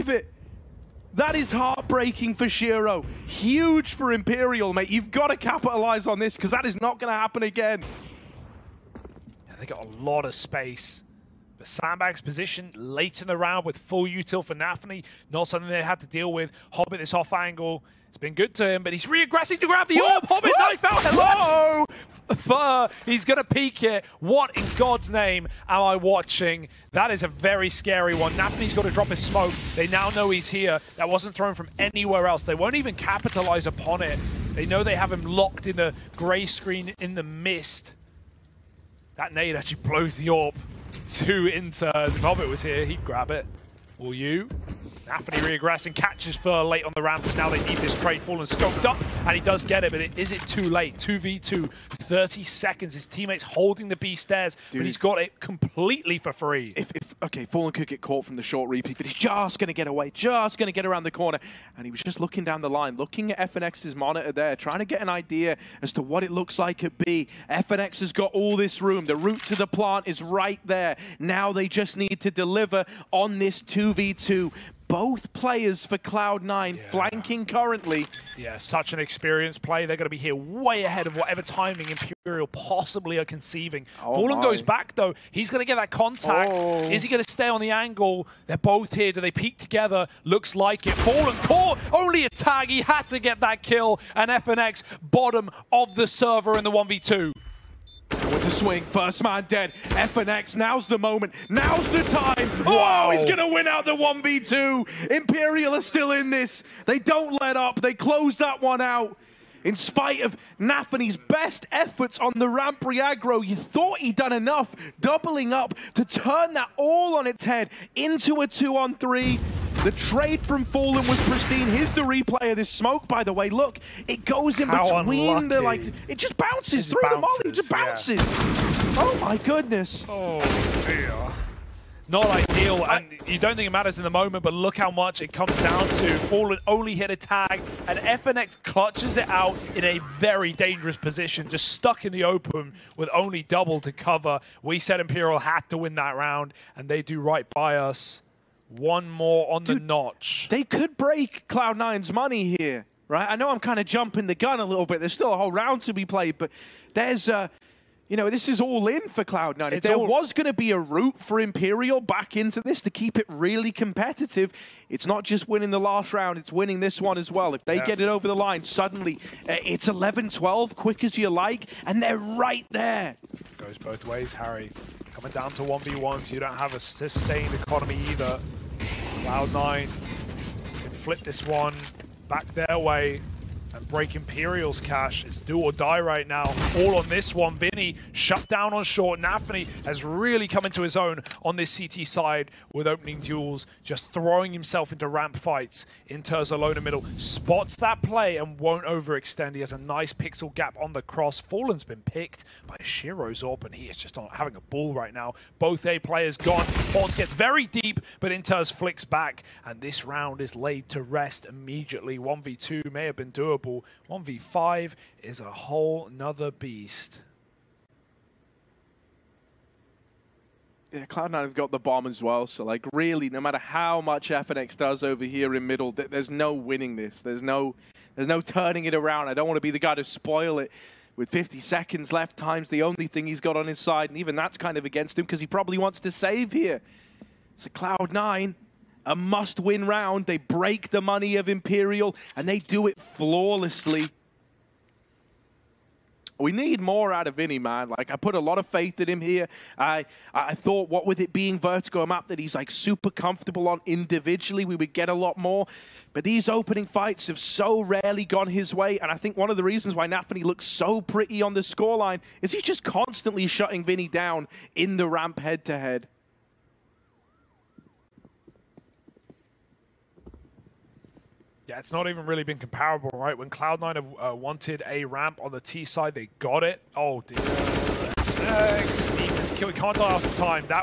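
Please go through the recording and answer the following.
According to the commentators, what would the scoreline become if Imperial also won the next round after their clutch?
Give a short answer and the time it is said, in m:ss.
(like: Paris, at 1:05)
11-12, at 2:49.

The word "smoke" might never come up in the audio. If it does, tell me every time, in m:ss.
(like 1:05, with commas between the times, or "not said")
0:29, 2:02.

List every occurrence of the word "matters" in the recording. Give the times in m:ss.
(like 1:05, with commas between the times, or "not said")
2:13, 3:43.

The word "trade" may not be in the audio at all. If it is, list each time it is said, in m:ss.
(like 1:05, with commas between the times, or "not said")
0:47, 1:59.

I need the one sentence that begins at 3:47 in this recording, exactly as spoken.
There's no, there's no turning it around.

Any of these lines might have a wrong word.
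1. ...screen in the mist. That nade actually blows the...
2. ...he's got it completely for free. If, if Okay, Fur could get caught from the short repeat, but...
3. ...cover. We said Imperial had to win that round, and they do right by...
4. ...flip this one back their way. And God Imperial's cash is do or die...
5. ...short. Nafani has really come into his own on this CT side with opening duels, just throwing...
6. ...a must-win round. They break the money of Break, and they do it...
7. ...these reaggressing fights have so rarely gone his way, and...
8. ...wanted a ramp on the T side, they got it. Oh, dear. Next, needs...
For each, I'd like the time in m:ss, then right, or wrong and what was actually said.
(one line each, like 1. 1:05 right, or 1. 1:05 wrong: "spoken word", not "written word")
1. 0:36 right
2. 0:54 wrong: "Fallen", not "Fur"
3. 2:23 right
4. 3:00 wrong: "Break", not "God"
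5. 3:08 right
6. 3:59 wrong: "Imperial", not "Break"
7. 4:16 wrong: "opening", not "reaggressing"
8. 4:34 right.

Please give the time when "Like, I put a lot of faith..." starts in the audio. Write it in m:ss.
4:07.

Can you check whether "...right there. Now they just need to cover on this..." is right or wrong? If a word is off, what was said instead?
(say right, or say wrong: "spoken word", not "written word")
wrong: "deliver", not "cover".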